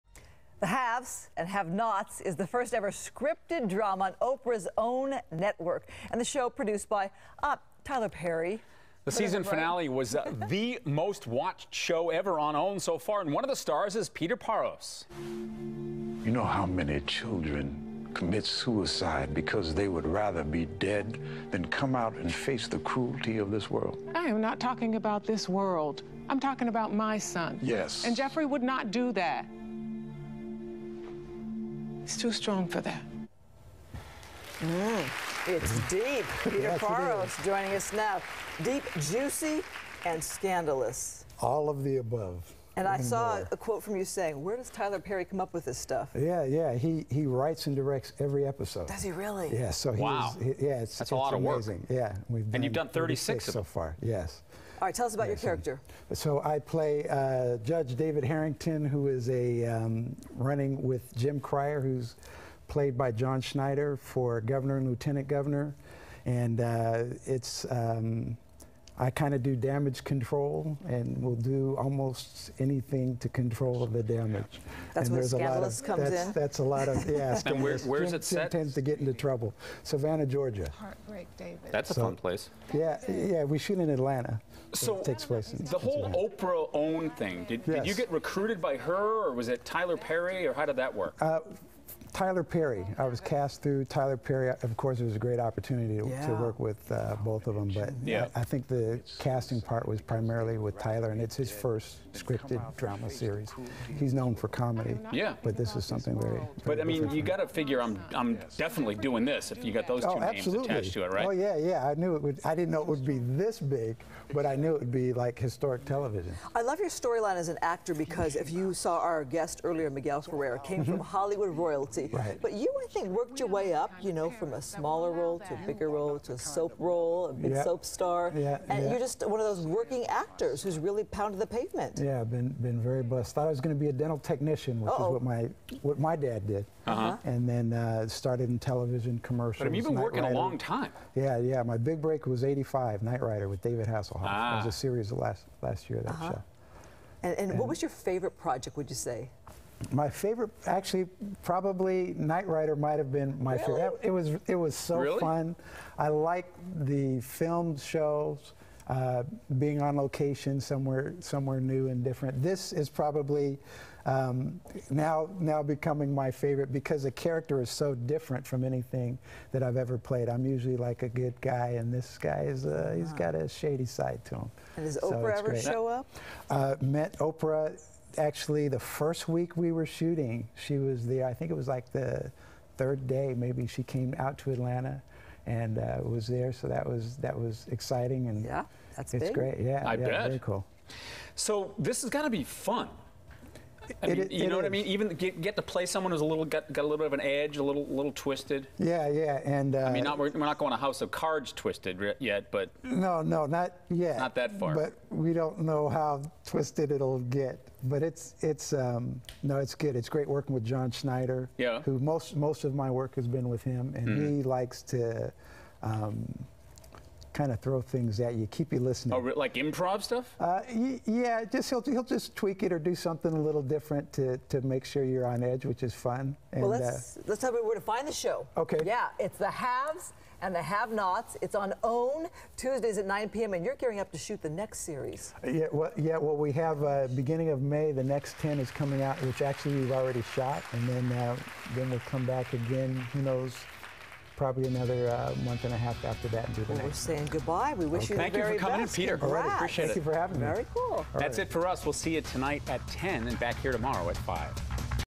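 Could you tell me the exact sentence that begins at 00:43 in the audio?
a quote from you saying, where does Tyler Perry come up with this stuff?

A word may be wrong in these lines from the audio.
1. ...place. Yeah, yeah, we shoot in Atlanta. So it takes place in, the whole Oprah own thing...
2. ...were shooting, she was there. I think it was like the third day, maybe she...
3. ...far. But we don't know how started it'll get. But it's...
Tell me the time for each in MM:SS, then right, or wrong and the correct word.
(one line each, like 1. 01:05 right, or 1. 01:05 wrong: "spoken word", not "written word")
1. 01:22 right
2. 02:59 right
3. 03:24 wrong: "twisted", not "started".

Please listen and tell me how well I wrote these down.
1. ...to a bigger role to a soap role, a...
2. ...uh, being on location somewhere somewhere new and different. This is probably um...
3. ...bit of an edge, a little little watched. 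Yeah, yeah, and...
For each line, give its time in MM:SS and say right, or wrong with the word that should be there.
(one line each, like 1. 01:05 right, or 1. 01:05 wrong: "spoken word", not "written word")
1. 02:05 right
2. 02:38 right
3. 03:16 wrong: "twisted", not "watched".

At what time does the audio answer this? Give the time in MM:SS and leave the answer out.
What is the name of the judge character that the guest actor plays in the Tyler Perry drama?
00:57.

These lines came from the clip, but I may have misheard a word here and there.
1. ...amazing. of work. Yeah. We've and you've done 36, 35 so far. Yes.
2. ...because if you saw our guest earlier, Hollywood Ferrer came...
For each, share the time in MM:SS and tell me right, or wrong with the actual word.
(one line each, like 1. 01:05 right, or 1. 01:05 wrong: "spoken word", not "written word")
1. 00:51 wrong: "36", not "35"
2. 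01:57 wrong: "Miguel", not "Hollywood".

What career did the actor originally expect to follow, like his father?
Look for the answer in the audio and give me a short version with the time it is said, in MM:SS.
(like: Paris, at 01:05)
Dental technician, at 02:13.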